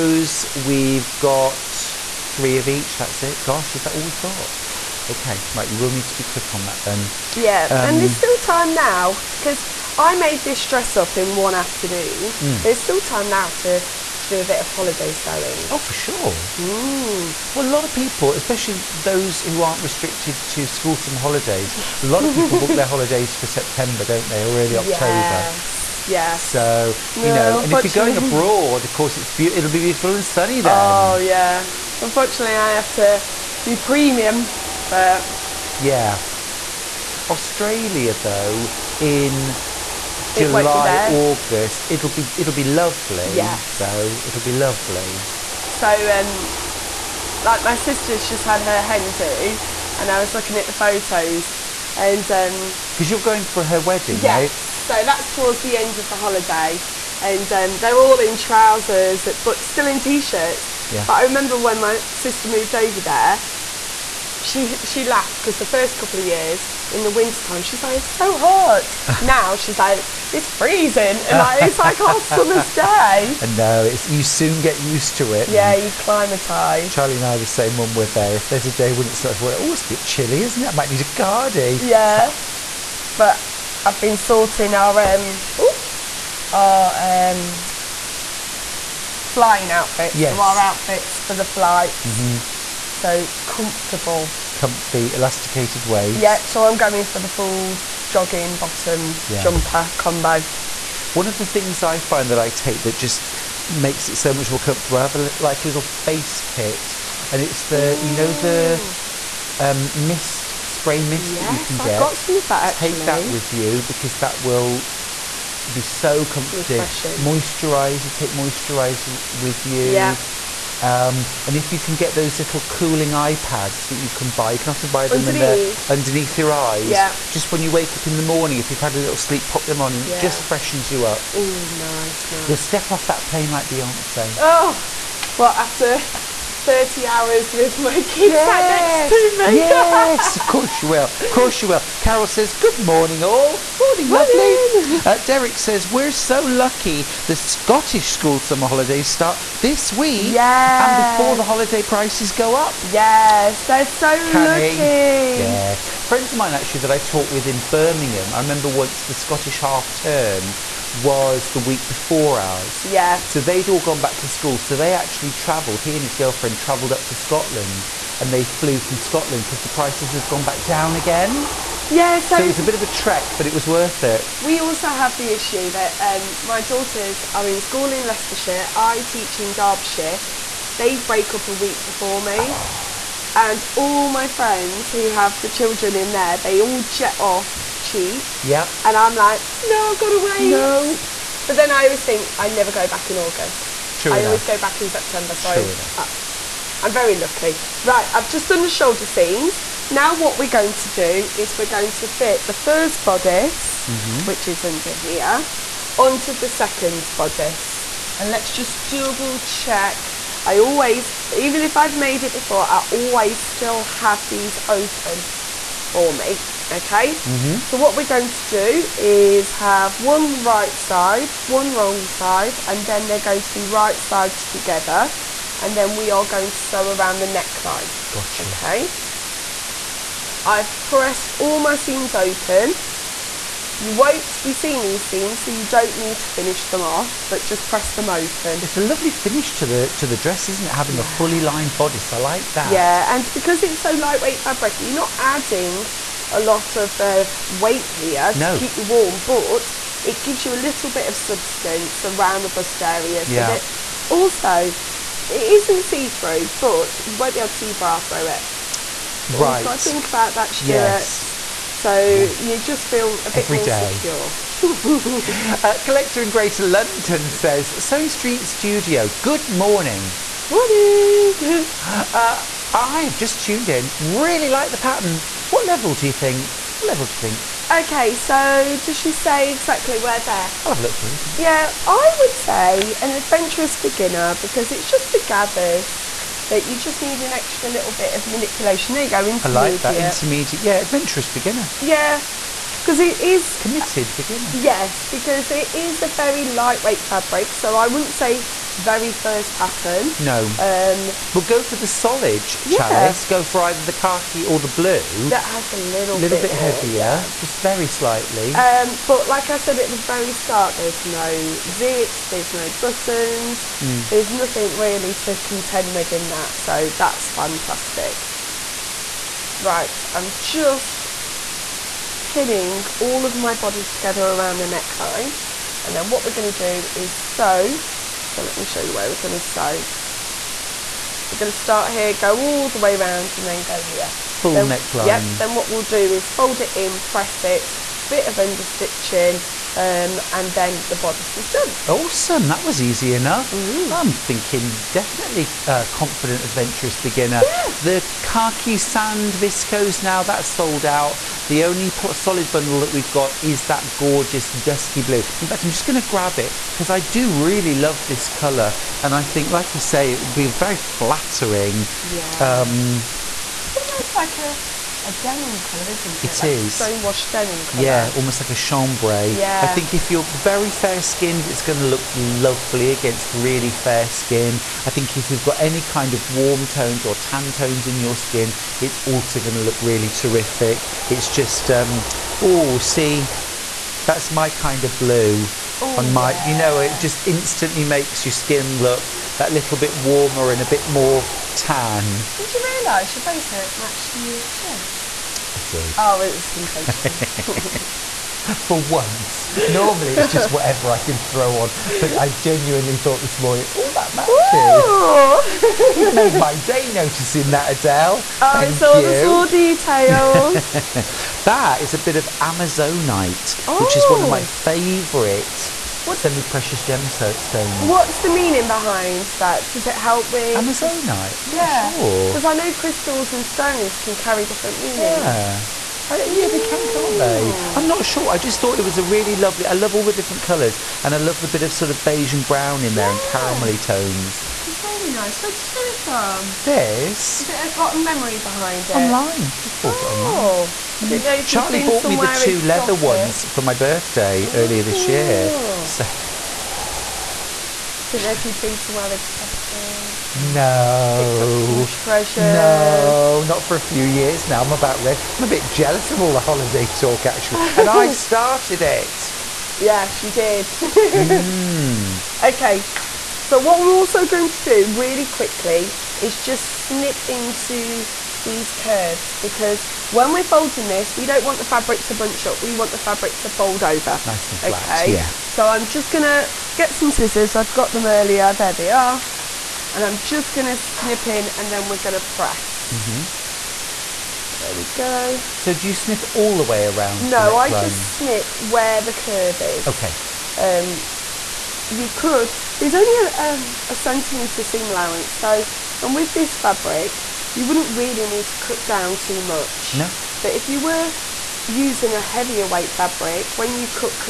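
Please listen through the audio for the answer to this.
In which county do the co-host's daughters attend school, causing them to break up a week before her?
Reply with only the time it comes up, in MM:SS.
02:58.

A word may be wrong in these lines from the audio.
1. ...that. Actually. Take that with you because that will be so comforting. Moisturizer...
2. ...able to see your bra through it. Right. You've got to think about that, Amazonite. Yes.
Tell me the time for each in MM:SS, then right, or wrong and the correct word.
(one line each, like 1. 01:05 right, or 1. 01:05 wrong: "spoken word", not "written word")
1. 01:52 right
2. 04:17 wrong: "Stuart", not "Amazonite".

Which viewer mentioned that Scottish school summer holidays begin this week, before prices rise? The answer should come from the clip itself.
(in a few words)
Derek.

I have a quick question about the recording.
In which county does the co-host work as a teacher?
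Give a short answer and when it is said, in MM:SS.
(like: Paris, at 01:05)
Derbyshire, at 02:59.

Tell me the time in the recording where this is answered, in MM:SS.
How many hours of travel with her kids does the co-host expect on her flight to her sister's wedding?
02:16.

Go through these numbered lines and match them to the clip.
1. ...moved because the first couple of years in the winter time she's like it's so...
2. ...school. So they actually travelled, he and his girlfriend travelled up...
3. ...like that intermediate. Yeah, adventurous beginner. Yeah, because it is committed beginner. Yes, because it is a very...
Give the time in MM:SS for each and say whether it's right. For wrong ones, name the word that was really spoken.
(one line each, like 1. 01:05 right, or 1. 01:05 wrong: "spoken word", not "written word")
1. 01:05 wrong: "laughed", not "moved"
2. 02:44 right
3. 04:49 right.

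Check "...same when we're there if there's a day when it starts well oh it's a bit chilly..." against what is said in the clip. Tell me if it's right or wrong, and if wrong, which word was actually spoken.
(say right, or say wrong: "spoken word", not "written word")
right.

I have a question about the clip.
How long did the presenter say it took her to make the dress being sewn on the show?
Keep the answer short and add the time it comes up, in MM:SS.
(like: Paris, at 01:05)
One afternoon, at 00:11.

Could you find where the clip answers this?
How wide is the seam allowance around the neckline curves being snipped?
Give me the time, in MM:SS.
08:13.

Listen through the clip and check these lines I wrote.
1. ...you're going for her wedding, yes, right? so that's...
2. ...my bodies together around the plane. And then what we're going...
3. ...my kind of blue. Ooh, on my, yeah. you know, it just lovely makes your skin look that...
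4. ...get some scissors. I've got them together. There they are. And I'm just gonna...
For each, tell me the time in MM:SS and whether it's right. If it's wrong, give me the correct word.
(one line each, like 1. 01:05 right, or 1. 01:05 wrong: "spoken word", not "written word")
1. 00:53 right
2. 05:23 wrong: "neckline", not "plane"
3. 06:24 wrong: "instantly", not "lovely"
4. 07:56 wrong: "earlier", not "together".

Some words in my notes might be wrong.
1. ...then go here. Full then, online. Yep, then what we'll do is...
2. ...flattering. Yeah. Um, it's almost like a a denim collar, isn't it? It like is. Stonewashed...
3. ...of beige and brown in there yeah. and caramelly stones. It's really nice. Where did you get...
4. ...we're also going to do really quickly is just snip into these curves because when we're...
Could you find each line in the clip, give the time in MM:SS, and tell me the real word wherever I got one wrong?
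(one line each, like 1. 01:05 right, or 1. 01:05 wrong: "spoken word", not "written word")
1. 05:33 wrong: "neckline", not "online"
2. 06:00 right
3. 07:11 wrong: "tones", not "stones"
4. 07:43 right.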